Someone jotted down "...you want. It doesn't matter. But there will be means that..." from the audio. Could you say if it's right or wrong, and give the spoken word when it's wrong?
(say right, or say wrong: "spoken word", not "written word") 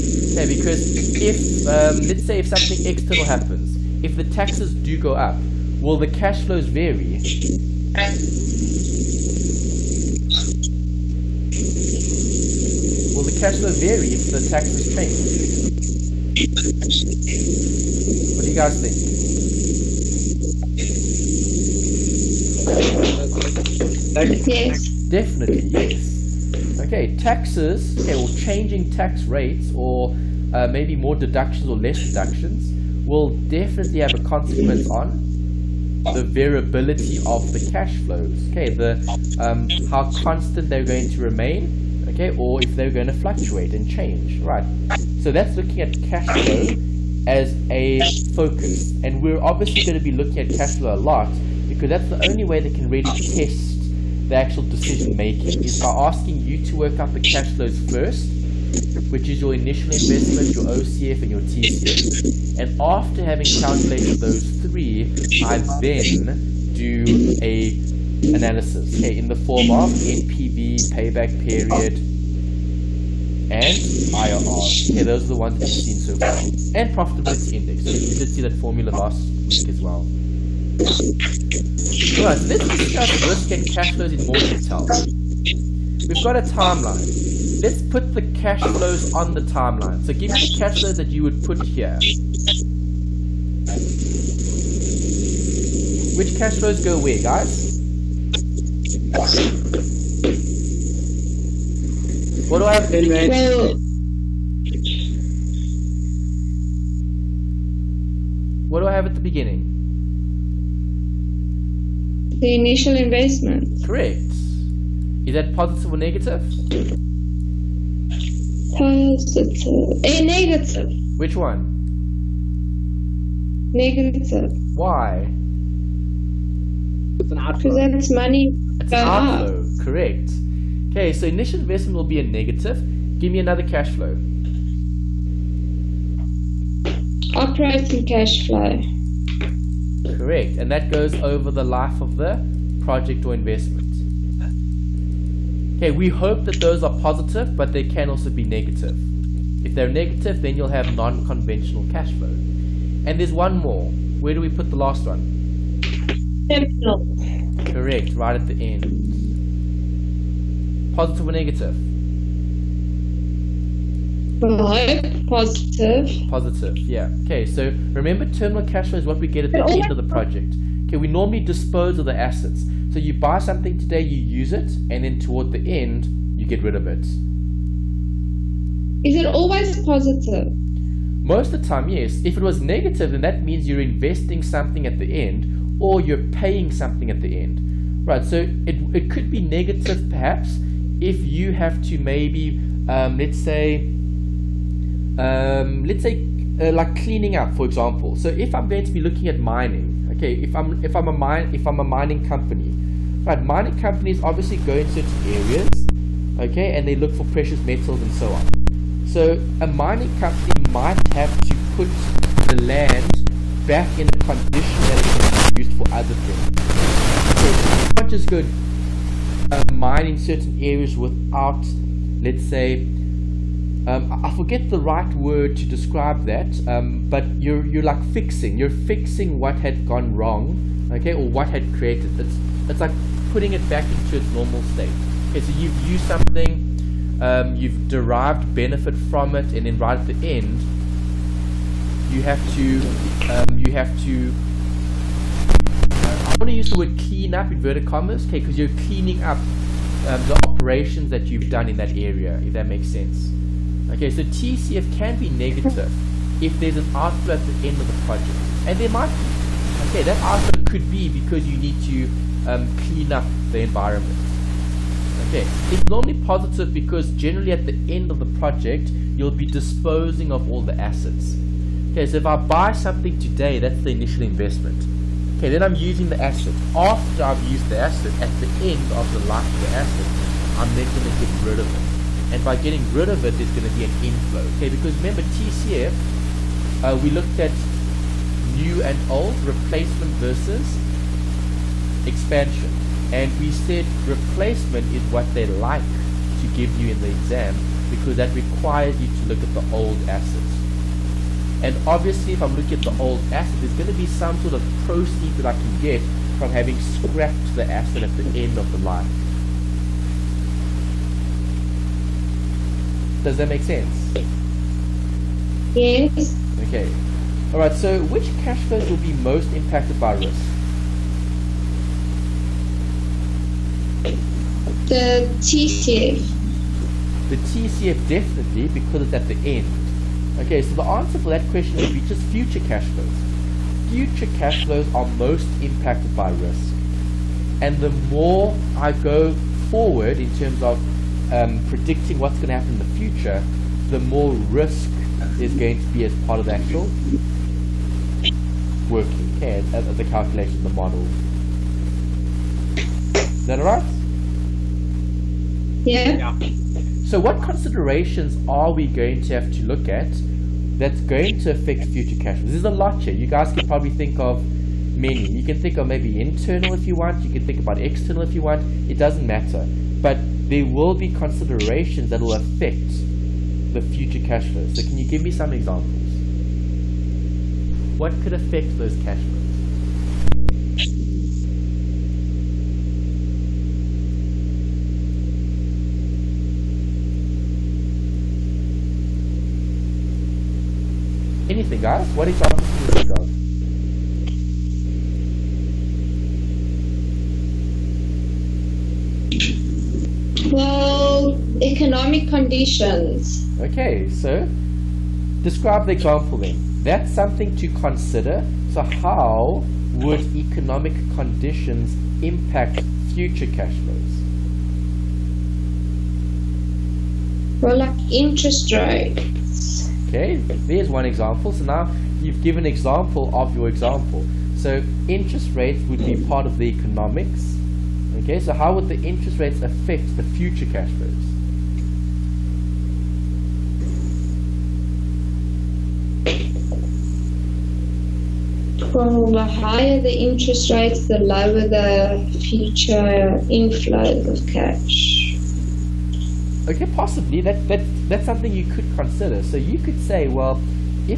wrong: "considerations", not "means".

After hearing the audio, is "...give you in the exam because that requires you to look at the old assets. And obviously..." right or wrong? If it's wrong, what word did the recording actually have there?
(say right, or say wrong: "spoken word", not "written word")
right.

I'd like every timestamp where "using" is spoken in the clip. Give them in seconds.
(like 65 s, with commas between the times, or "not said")
275 s.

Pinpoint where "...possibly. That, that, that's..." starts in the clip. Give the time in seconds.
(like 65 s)
446 s.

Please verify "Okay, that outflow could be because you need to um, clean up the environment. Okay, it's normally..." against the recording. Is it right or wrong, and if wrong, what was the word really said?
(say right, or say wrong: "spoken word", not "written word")
right.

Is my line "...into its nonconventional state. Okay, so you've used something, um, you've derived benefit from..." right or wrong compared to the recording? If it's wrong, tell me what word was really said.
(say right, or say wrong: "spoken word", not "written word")
wrong: "normal", not "nonconventional".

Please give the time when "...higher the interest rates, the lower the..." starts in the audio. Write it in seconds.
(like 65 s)
439 s.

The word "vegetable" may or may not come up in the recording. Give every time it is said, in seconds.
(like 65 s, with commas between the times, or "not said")
not said.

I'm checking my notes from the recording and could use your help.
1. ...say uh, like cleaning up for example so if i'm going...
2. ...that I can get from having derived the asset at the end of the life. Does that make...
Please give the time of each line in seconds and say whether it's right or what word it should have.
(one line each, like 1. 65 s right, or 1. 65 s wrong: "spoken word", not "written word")
1. 196 s right
2. 305 s wrong: "scrapped", not "derived".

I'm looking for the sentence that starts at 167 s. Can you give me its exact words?
Okay, so remember terminal cash flow is what we get at the end of the project.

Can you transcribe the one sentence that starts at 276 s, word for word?
After I've used the asset, at the end of the life of the asset, I'm then going to get rid of it.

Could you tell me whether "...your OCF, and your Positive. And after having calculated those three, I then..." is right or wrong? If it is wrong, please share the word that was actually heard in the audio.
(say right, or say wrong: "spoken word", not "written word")
wrong: "TCF", not "Positive".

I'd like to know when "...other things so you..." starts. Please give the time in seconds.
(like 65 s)
215 s.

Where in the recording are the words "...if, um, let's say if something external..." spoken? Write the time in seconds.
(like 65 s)
1 s.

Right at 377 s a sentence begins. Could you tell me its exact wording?
What could affect those cash flows?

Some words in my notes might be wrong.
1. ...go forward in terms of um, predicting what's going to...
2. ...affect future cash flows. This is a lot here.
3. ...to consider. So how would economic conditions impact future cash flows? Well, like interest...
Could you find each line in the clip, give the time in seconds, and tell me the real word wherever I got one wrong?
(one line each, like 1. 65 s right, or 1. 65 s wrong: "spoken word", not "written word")
1. 338 s right
2. 361 s right
3. 407 s right.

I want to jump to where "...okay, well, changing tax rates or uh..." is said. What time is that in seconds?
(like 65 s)
27 s.